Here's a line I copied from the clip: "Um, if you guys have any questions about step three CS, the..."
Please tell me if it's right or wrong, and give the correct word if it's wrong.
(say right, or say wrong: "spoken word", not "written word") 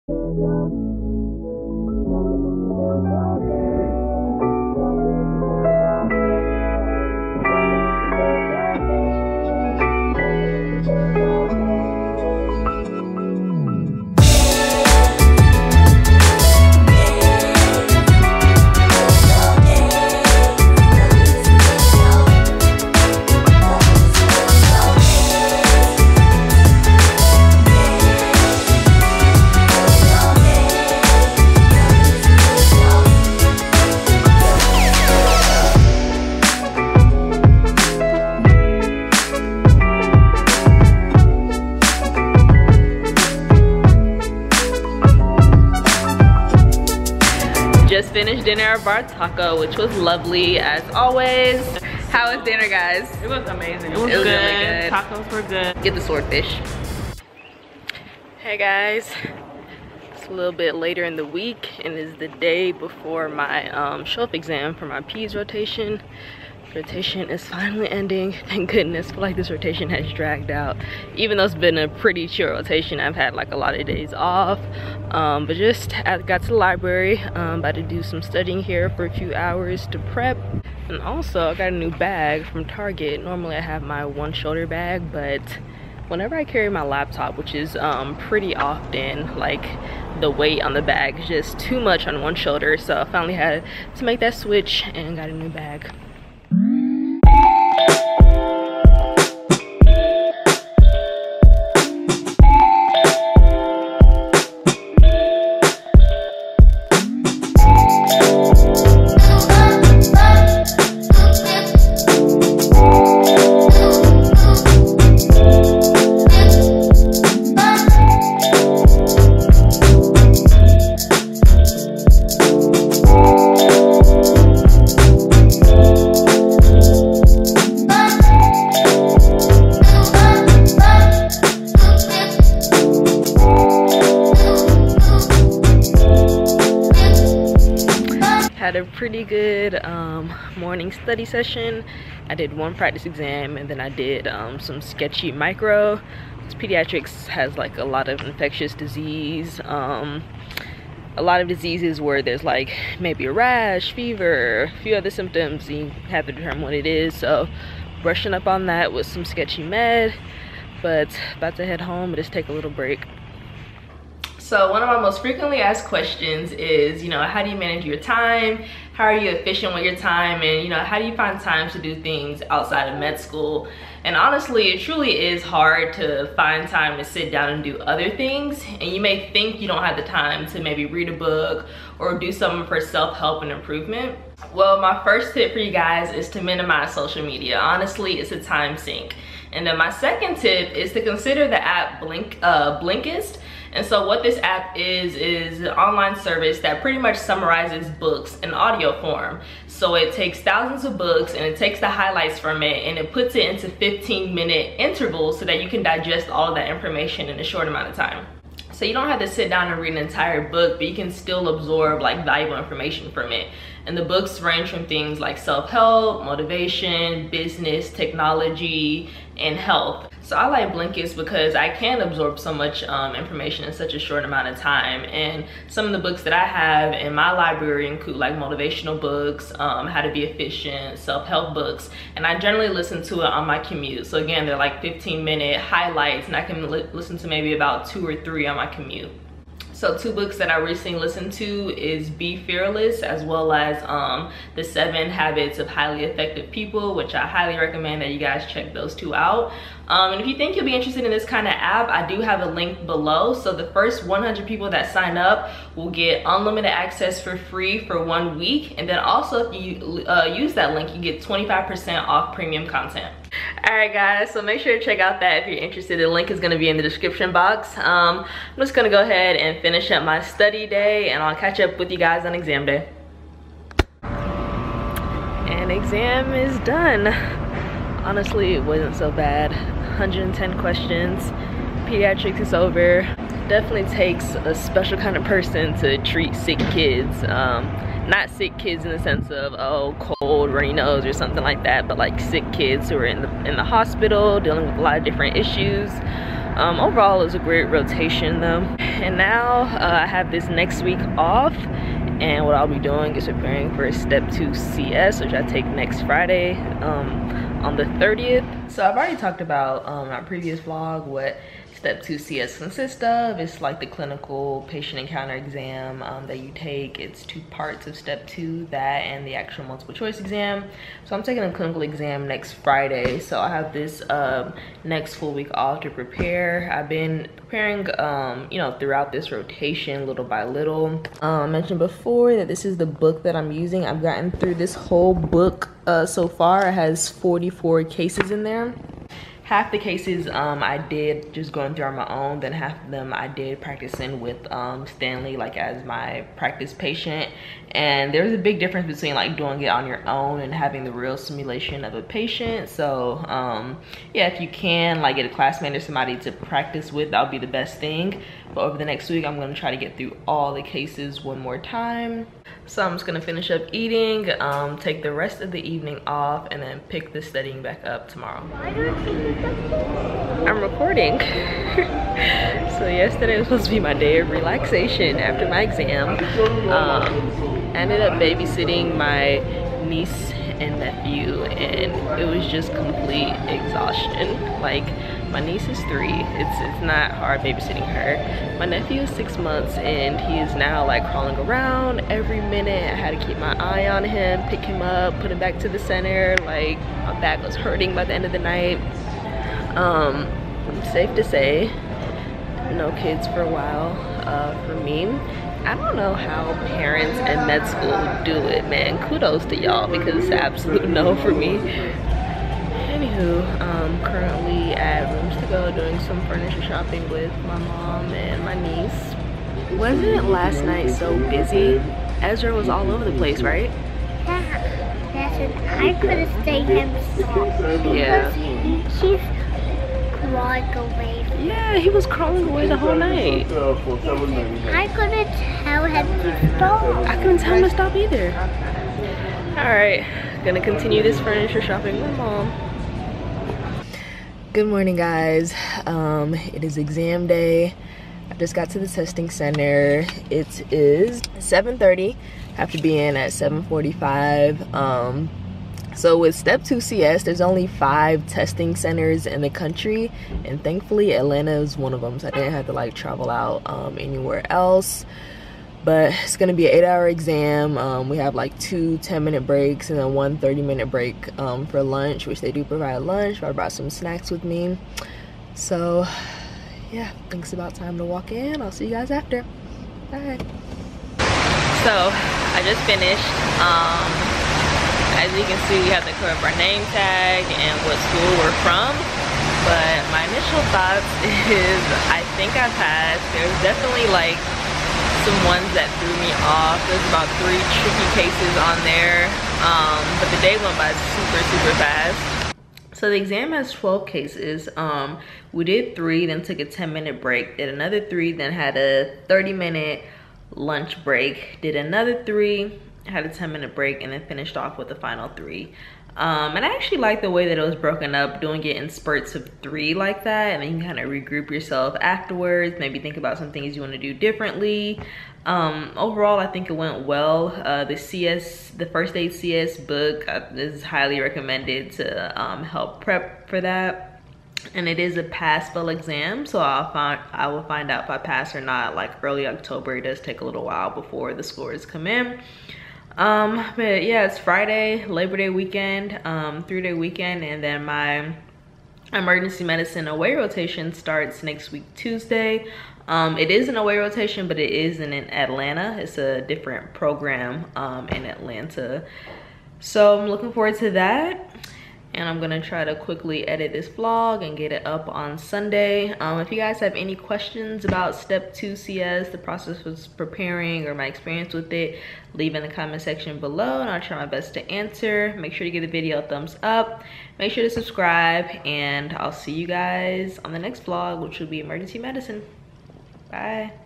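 wrong: "two", not "three".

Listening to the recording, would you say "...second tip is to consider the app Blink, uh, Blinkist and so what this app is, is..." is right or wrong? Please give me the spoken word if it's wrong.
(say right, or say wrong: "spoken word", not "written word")
right.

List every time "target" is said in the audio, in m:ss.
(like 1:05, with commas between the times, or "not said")
1:22.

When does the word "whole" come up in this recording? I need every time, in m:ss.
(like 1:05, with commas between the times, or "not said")
5:34, 7:12.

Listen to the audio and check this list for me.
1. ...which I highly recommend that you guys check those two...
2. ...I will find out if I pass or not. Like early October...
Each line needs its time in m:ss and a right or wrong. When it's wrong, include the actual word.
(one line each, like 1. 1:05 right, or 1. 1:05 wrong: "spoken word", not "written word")
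1. 4:06 right
2. 8:57 right.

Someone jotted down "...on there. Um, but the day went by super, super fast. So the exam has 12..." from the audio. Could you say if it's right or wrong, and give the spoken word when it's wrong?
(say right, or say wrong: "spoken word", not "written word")
right.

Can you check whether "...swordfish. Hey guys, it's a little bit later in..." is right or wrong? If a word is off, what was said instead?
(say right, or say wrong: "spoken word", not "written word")
right.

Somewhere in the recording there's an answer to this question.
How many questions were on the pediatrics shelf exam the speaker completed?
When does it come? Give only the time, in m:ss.
4:40.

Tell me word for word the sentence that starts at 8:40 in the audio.
And then you kind of regroup yourself afterwards, maybe think about some things you want to do differently.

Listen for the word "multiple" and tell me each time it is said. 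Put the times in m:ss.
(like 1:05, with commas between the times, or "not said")
5:19.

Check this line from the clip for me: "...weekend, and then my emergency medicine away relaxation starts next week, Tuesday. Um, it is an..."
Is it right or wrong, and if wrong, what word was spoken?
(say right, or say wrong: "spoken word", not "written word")
wrong: "rotation", not "relaxation".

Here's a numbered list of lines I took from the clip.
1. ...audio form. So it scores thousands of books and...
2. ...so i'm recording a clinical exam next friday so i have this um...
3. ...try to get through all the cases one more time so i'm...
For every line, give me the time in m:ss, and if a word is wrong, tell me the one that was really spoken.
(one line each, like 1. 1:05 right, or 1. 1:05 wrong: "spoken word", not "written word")
1. 3:18 wrong: "takes", not "scores"
2. 5:21 wrong: "taking", not "recording"
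3. 5:59 right.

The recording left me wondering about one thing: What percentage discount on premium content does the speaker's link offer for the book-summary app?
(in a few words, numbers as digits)
25%.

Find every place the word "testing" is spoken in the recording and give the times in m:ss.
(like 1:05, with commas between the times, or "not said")
7:28, 7:38.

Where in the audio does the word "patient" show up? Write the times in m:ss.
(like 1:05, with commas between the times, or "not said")
5:14, 5:46, 5:52.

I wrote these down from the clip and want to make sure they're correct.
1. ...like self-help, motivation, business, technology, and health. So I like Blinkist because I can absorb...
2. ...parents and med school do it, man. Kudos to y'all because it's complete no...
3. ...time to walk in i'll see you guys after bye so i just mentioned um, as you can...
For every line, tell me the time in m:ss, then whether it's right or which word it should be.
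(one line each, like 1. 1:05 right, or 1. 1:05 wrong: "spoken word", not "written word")
1. 3:35 right
2. 6:46 wrong: "absolute", not "complete"
3. 7:57 wrong: "finished", not "mentioned".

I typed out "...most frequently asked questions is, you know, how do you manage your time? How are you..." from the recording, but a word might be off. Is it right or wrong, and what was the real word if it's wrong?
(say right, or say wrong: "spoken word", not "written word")
right.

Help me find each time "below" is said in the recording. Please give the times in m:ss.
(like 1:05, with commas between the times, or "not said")
4:12, 9:33.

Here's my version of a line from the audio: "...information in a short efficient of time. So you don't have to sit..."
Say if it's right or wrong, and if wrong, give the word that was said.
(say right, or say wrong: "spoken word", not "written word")
wrong: "amount", not "efficient".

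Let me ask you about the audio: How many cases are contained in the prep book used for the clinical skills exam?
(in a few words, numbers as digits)
44.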